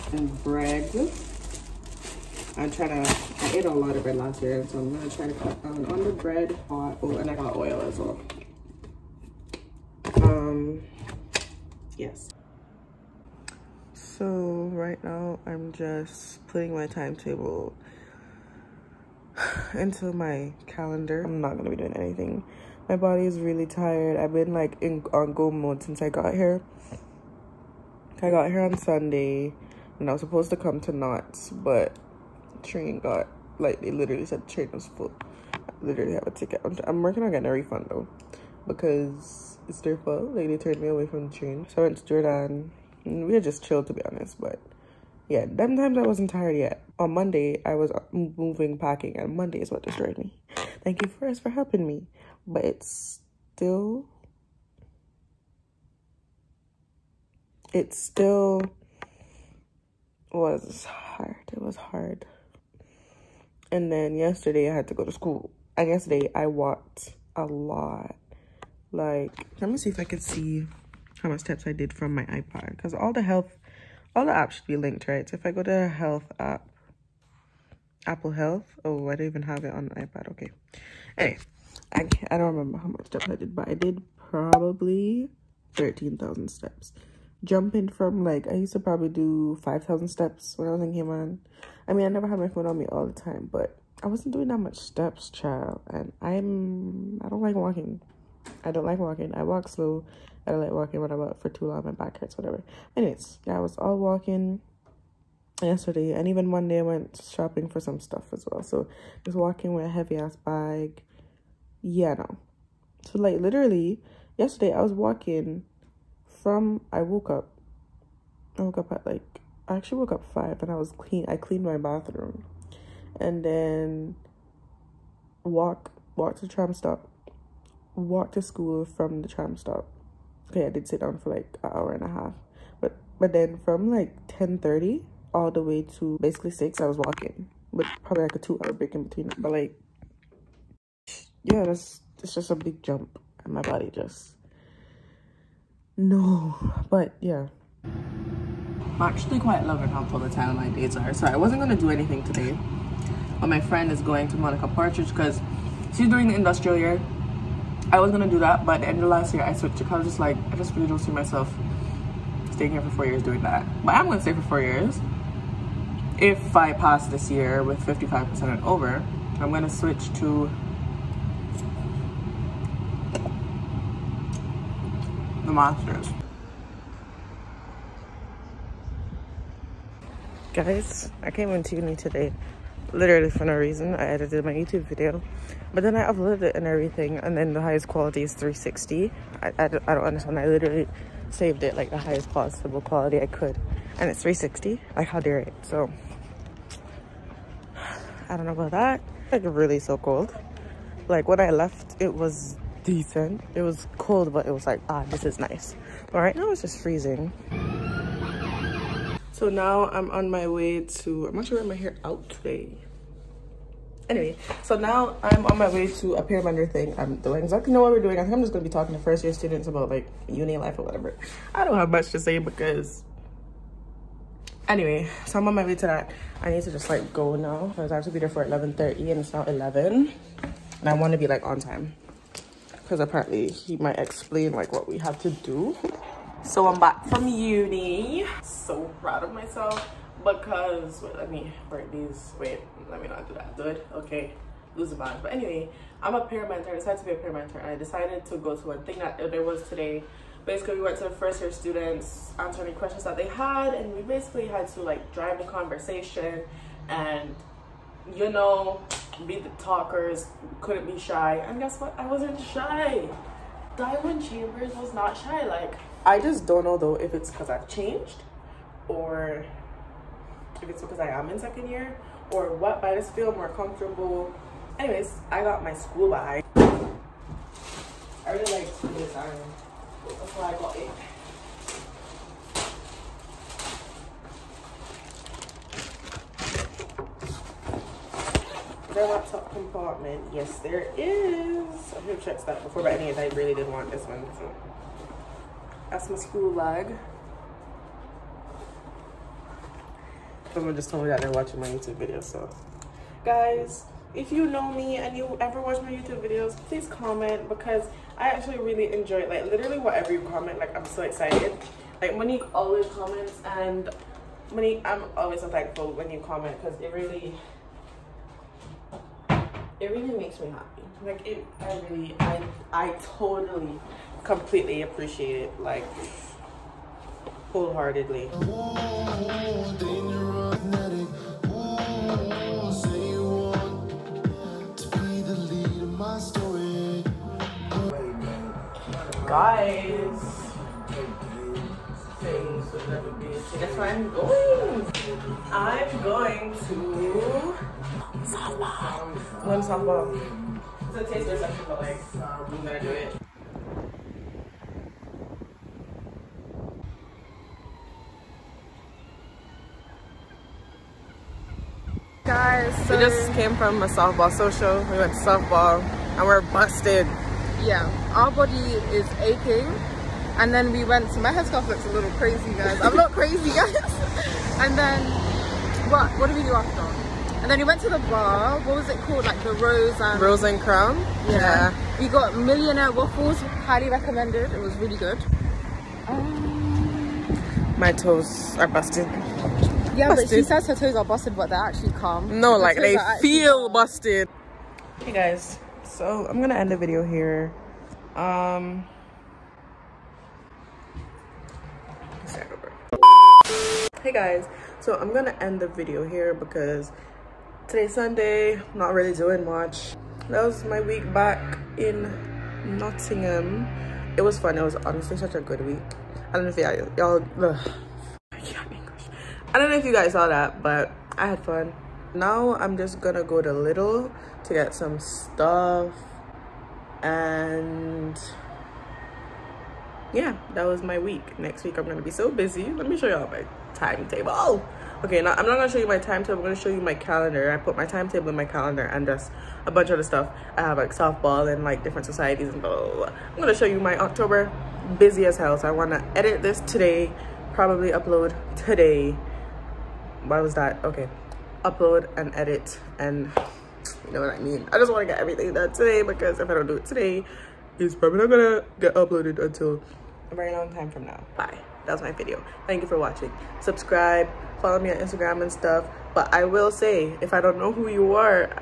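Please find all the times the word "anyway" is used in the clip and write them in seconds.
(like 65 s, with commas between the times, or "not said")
81 s, 102 s, 214 s, 224 s, 245 s, 274 s, 292 s.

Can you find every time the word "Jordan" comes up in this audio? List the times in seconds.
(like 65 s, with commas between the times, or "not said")
42 s.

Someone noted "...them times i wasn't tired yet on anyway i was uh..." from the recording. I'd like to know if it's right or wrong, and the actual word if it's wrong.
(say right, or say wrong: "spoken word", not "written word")
wrong: "monday", not "anyway".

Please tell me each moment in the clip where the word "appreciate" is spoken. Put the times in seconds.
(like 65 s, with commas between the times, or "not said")
324 s.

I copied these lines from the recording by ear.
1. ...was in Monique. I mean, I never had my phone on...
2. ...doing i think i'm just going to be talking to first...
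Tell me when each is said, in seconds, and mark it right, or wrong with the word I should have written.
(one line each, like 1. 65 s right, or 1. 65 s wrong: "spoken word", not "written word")
1. 90 s wrong: "Cayman", not "Monique"
2. 218 s right.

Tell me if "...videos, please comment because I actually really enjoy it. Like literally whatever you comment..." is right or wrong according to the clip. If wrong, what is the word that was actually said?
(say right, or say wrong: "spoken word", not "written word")
right.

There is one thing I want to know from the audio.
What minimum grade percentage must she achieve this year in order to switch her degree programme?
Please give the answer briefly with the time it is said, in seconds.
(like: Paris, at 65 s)
55%, at 167 s.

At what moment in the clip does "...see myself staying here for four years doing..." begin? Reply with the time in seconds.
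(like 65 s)
160 s.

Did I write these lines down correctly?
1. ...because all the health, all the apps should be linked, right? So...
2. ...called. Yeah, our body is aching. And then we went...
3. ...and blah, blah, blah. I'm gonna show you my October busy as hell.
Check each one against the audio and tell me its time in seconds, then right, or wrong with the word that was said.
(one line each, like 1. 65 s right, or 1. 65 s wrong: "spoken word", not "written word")
1. 72 s right
2. 366 s wrong: "busted", not "called"
3. 442 s right.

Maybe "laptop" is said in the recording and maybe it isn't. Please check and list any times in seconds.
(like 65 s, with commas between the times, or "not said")
289 s.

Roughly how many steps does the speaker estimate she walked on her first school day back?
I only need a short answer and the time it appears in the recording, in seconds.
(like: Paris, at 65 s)
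13,000, at 85 s.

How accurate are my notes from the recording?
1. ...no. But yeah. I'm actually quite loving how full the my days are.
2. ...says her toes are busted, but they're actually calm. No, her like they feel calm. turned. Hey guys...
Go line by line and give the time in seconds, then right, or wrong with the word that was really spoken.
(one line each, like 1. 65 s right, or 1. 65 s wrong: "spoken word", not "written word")
1. 145 s right
2. 390 s wrong: "busted", not "turned".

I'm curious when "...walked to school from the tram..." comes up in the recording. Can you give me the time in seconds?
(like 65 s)
127 s.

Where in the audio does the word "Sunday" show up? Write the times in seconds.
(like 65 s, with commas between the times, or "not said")
28 s, 407 s.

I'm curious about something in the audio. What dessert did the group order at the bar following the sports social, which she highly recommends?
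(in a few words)
Millionaire Waffles.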